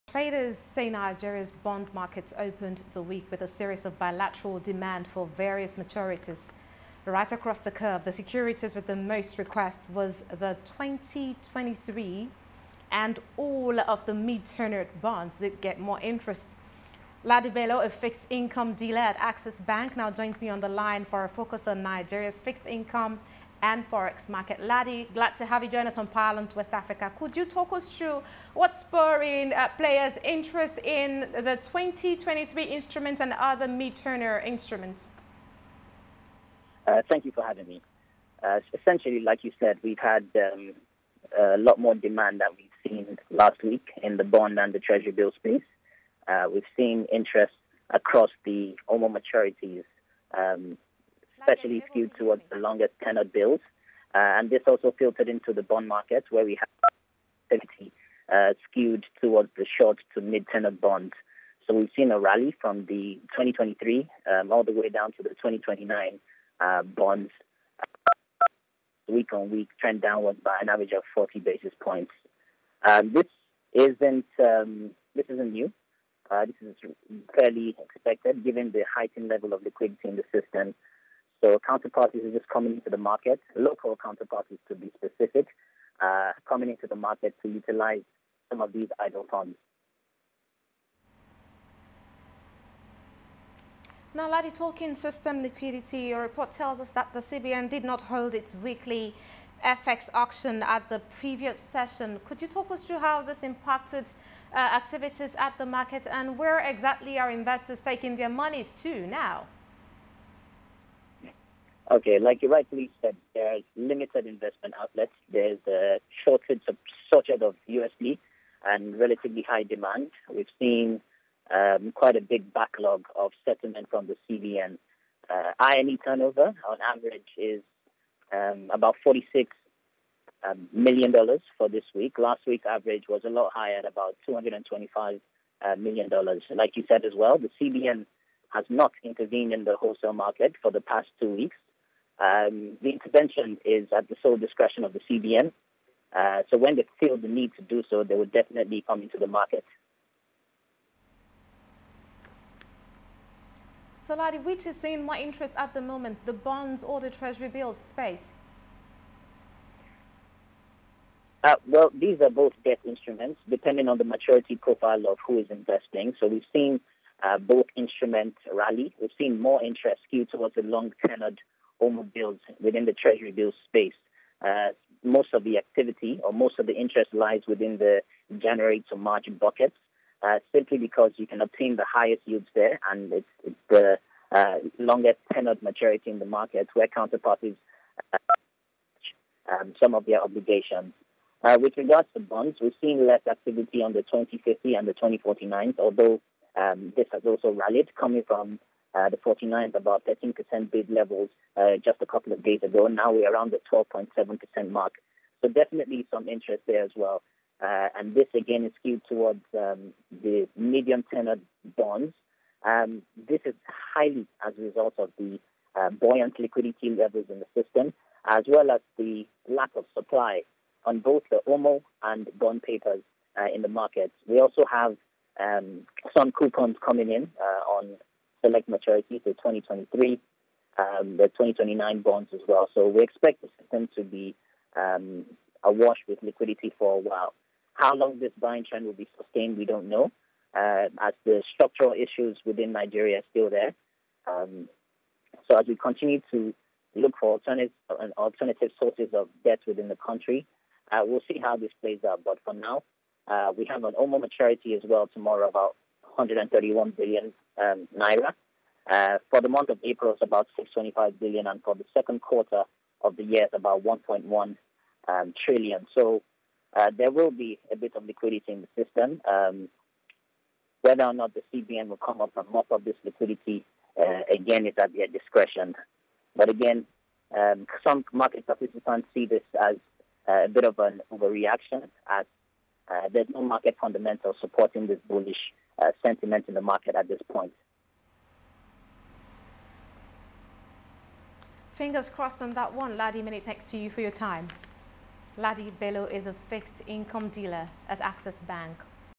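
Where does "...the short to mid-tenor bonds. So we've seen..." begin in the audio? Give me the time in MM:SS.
00:59.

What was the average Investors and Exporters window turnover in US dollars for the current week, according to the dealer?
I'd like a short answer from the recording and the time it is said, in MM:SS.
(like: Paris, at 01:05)
$46 million, at 02:09.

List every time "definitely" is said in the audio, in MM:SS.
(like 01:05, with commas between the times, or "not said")
02:28, 03:25.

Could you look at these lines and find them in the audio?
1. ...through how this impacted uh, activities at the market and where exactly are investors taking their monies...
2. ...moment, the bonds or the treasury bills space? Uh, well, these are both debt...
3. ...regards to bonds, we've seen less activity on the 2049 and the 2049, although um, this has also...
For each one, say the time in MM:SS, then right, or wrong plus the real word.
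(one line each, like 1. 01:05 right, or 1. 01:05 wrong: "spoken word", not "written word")
1. 01:42 right
2. 02:35 right
3. 03:11 wrong: "2050", not "2049".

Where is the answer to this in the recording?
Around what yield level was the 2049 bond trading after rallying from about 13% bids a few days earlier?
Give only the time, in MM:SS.
03:23.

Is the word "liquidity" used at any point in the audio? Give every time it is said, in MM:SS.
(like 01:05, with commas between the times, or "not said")
01:19, 01:35, 03:36, 03:56, 04:28, 04:33.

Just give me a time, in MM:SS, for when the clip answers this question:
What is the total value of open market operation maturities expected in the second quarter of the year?
04:23.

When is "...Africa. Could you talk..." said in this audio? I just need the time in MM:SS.
00:26.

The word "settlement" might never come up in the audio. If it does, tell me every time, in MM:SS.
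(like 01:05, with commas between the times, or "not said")
02:03.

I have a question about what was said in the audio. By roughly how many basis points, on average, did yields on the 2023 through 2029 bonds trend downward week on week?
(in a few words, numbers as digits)
40 basis points.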